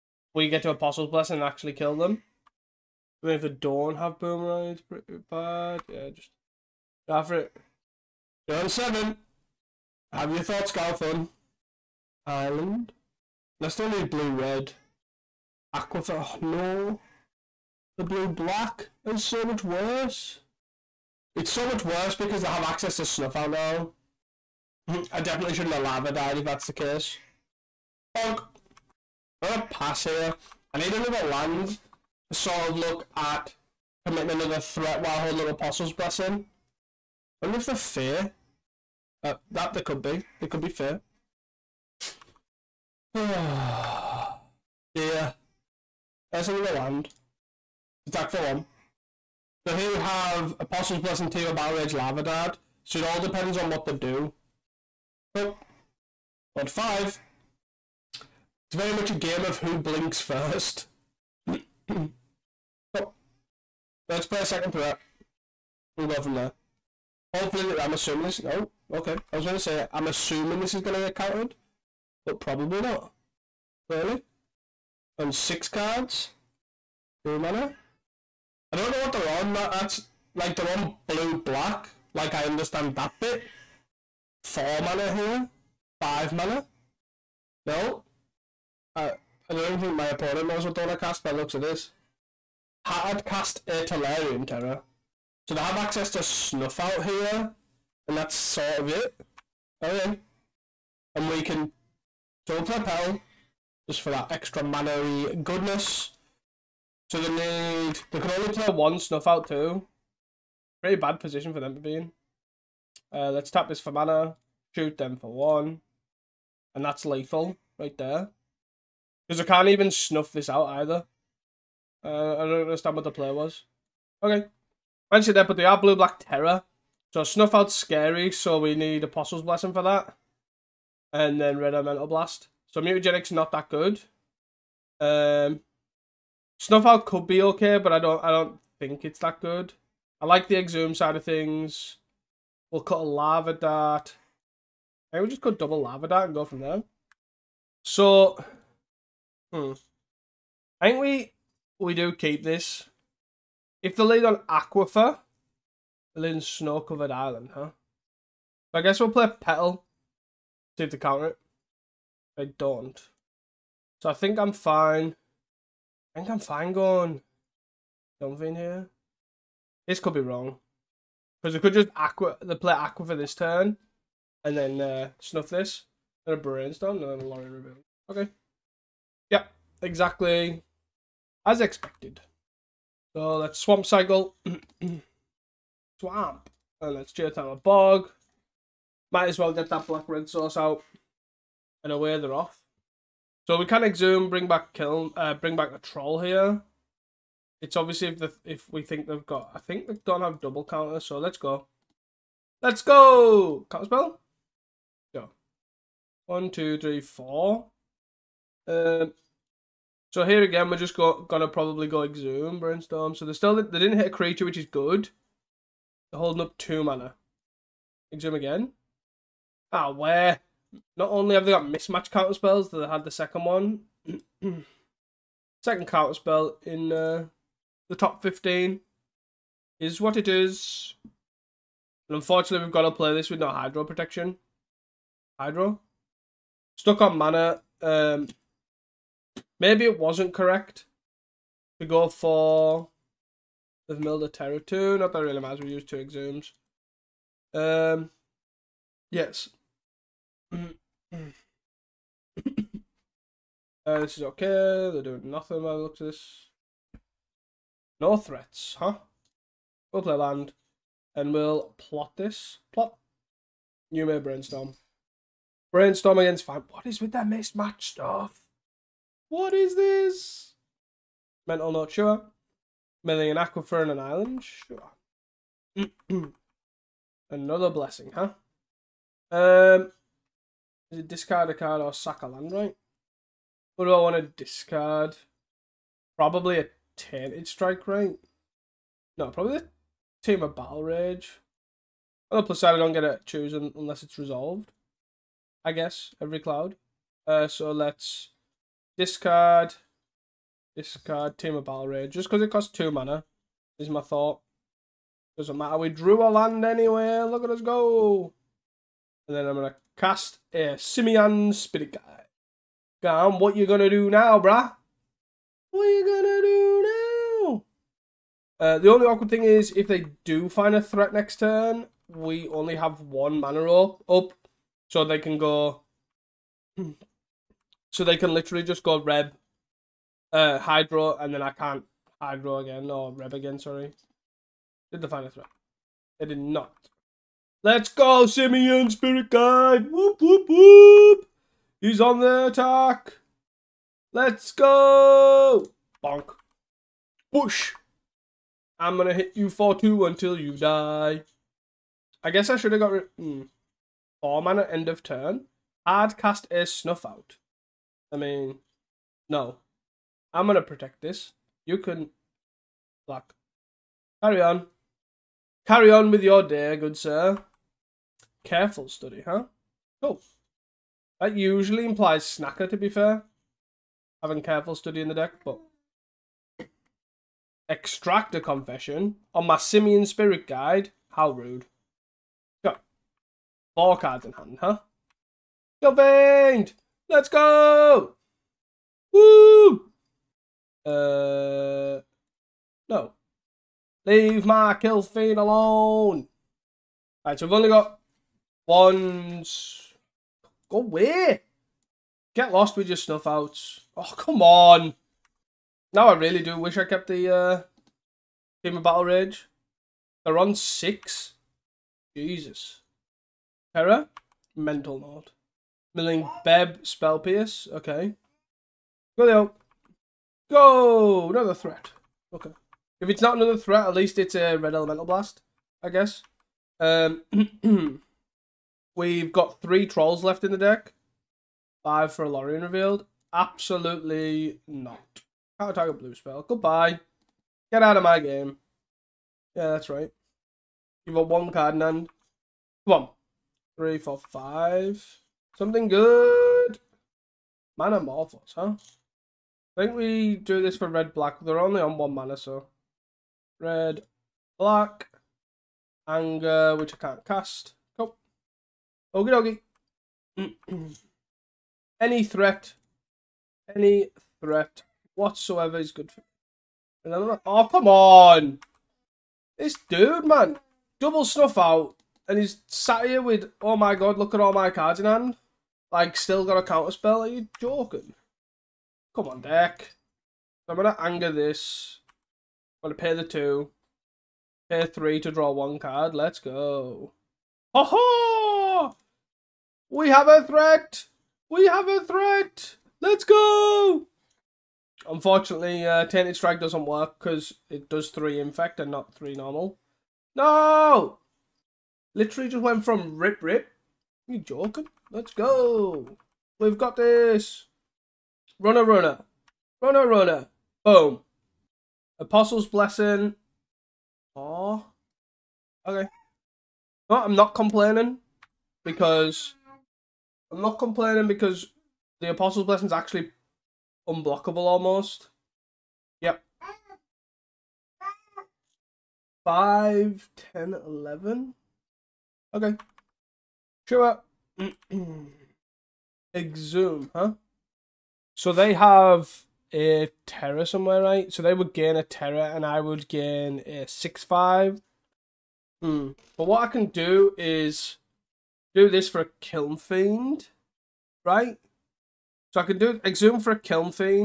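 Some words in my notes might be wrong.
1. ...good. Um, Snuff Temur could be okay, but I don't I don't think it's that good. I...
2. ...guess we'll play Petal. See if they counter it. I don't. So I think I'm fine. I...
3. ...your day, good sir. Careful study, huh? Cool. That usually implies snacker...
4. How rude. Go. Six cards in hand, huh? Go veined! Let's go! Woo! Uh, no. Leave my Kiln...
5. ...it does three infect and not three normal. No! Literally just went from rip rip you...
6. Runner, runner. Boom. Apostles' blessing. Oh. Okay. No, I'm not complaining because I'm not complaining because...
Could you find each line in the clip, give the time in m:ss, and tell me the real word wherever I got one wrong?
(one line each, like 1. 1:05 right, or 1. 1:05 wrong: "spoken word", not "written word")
1. 2:13 wrong: "Out", not "Temur"
2. 2:38 right
3. 6:06 right
4. 6:21 wrong: "Four", not "Six"
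5. 8:17 right
6. 8:29 right.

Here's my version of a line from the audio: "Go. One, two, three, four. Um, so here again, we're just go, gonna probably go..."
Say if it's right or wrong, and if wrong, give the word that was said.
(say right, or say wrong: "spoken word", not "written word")
right.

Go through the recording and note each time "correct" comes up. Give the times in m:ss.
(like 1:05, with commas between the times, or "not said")
4:00.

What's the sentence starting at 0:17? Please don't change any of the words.
The blue black is so much worse.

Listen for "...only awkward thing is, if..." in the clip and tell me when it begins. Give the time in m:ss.
5:18.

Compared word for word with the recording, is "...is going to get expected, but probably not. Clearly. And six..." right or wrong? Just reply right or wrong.
wrong.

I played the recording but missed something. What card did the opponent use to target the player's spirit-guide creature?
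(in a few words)
Extract a Confession.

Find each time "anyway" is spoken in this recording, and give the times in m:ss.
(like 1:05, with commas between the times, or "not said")
5:06.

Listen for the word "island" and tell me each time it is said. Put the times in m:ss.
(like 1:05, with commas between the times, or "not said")
0:12, 2:37, 4:33.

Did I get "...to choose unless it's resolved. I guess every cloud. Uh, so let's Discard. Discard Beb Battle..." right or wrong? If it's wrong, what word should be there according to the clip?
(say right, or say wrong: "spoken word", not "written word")
wrong: "Temur", not "Beb".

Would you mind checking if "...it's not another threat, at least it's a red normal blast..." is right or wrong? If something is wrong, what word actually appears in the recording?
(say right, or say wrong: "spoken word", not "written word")
wrong: "elemental", not "normal".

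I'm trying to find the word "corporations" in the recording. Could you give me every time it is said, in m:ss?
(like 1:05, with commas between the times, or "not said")
not said.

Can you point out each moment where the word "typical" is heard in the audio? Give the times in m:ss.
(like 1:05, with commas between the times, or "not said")
not said.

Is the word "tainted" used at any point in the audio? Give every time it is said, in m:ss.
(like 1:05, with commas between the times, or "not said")
4:46, 8:16.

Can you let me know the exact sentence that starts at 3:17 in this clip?
It's obviously if the, if we think they've got, I think they've not have double counter.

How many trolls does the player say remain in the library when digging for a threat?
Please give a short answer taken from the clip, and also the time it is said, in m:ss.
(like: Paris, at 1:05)
3, at 7:08.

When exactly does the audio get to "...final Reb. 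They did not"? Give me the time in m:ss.
5:35.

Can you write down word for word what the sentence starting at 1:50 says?
Pretty bad position for them to be in.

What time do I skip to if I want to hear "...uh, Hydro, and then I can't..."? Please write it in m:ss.
5:30.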